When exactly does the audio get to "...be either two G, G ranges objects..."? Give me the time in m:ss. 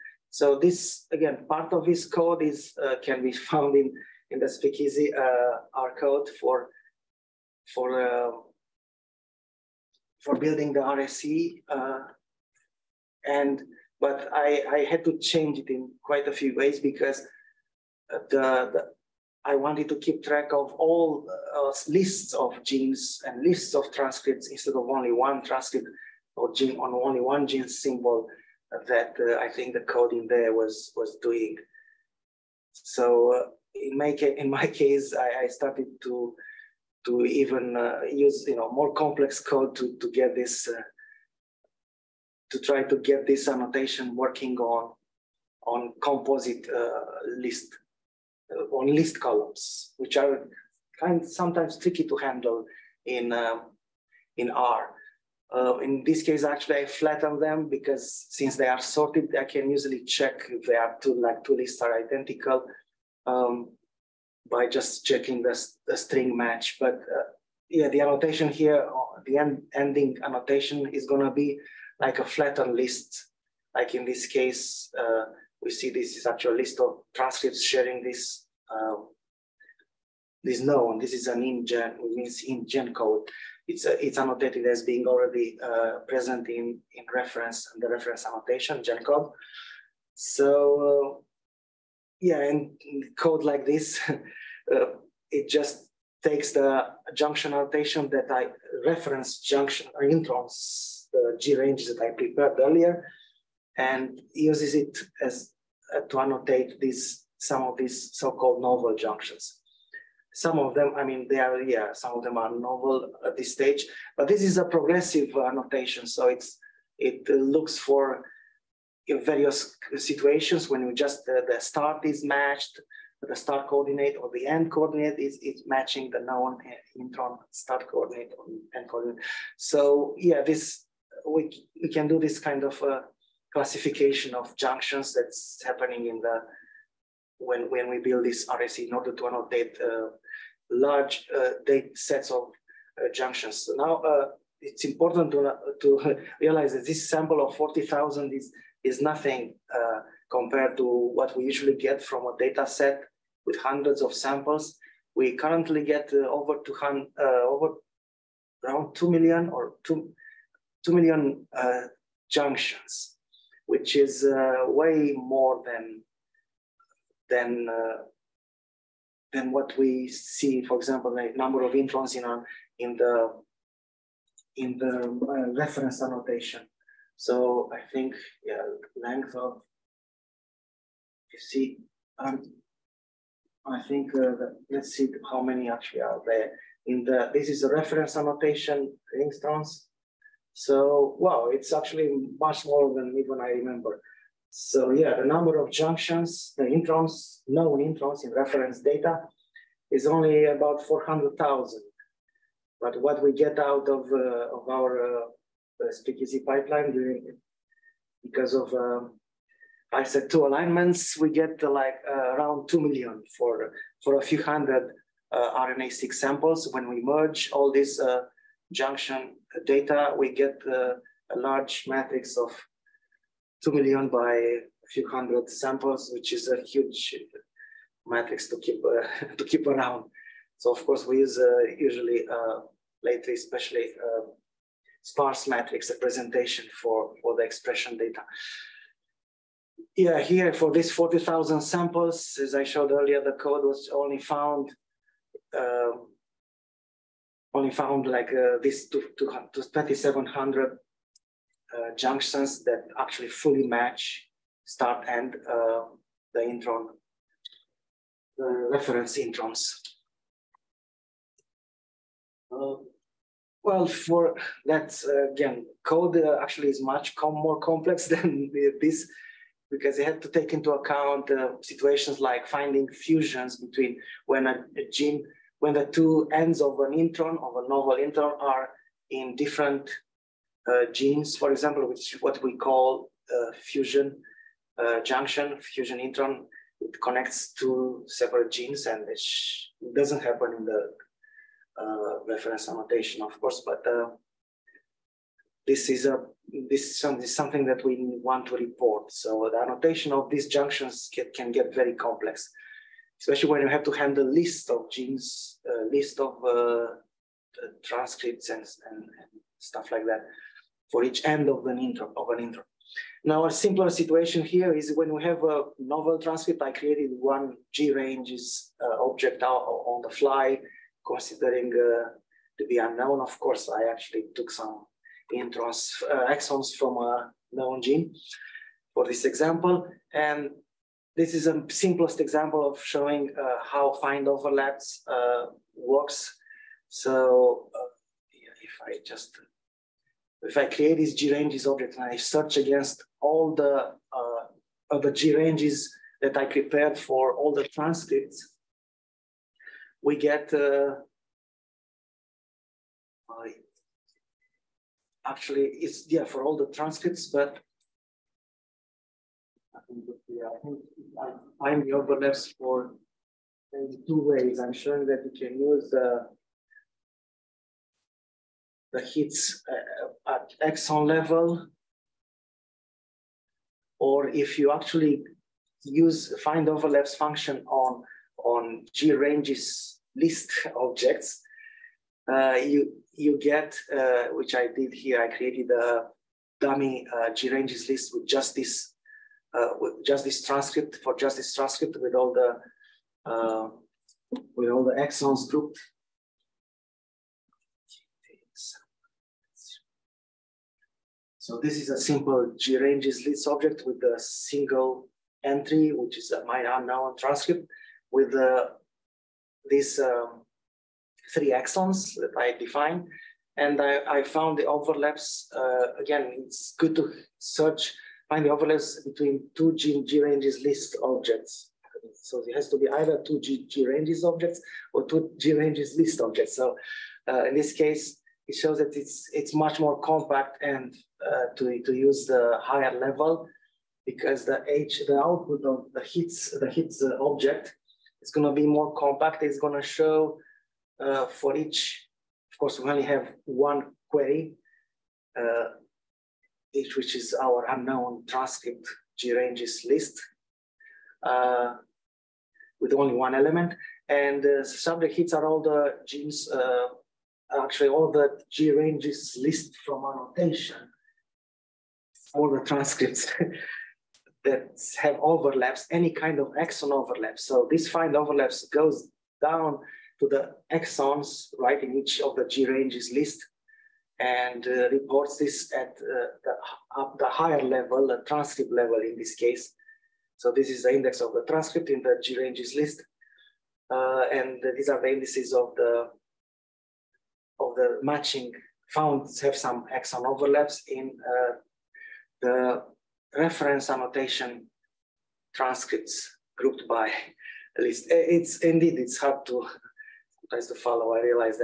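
7:02.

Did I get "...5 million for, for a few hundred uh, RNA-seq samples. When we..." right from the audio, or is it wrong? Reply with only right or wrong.
wrong.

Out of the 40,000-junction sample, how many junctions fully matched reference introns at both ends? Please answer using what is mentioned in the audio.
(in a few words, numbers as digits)
2,700.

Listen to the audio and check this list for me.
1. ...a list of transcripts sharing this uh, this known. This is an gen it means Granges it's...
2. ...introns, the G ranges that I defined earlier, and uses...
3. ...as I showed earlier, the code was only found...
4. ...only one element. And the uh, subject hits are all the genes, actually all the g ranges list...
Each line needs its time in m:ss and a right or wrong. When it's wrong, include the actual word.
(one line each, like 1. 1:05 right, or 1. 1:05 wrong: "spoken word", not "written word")
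1. 1:16 wrong: "GenCode", not "Granges"
2. 1:40 wrong: "prepared", not "defined"
3. 4:02 right
4. 7:32 right.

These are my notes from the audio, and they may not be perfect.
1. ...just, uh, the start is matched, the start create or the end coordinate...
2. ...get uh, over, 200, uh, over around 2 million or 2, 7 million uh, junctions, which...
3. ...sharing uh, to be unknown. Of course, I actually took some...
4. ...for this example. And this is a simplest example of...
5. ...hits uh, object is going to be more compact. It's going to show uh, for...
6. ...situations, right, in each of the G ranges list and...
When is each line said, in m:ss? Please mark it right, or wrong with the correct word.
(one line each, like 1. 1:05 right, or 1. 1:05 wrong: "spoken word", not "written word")
1. 2:00 wrong: "coordinate", not "create"
2. 2:35 wrong: "2", not "7"
3. 5:21 wrong: "considering", not "sharing"
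4. 5:28 right
5. 7:16 right
6. 7:50 wrong: "exons", not "situations".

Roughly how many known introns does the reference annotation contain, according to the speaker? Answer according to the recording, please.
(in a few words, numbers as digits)
About 400,000.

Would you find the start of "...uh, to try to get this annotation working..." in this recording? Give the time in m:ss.
0:40.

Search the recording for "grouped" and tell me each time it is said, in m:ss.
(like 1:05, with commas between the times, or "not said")
6:35, 8:16.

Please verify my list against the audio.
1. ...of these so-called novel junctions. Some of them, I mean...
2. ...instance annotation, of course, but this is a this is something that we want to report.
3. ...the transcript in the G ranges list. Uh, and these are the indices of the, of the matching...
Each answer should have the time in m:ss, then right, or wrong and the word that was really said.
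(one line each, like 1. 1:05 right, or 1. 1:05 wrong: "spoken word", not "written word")
1. 1:47 right
2. 4:52 wrong: "reference", not "instance"
3. 8:01 right.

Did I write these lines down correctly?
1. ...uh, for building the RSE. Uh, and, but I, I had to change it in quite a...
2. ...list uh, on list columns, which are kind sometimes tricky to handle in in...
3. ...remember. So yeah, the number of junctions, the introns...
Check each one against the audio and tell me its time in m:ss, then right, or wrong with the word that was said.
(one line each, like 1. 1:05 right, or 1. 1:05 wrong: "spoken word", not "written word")
1. 0:07 right
2. 0:47 right
3. 3:13 right.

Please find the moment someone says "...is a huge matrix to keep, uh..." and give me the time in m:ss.
3:46.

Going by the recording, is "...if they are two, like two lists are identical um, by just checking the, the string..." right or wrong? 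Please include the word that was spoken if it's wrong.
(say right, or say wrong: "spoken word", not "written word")
right.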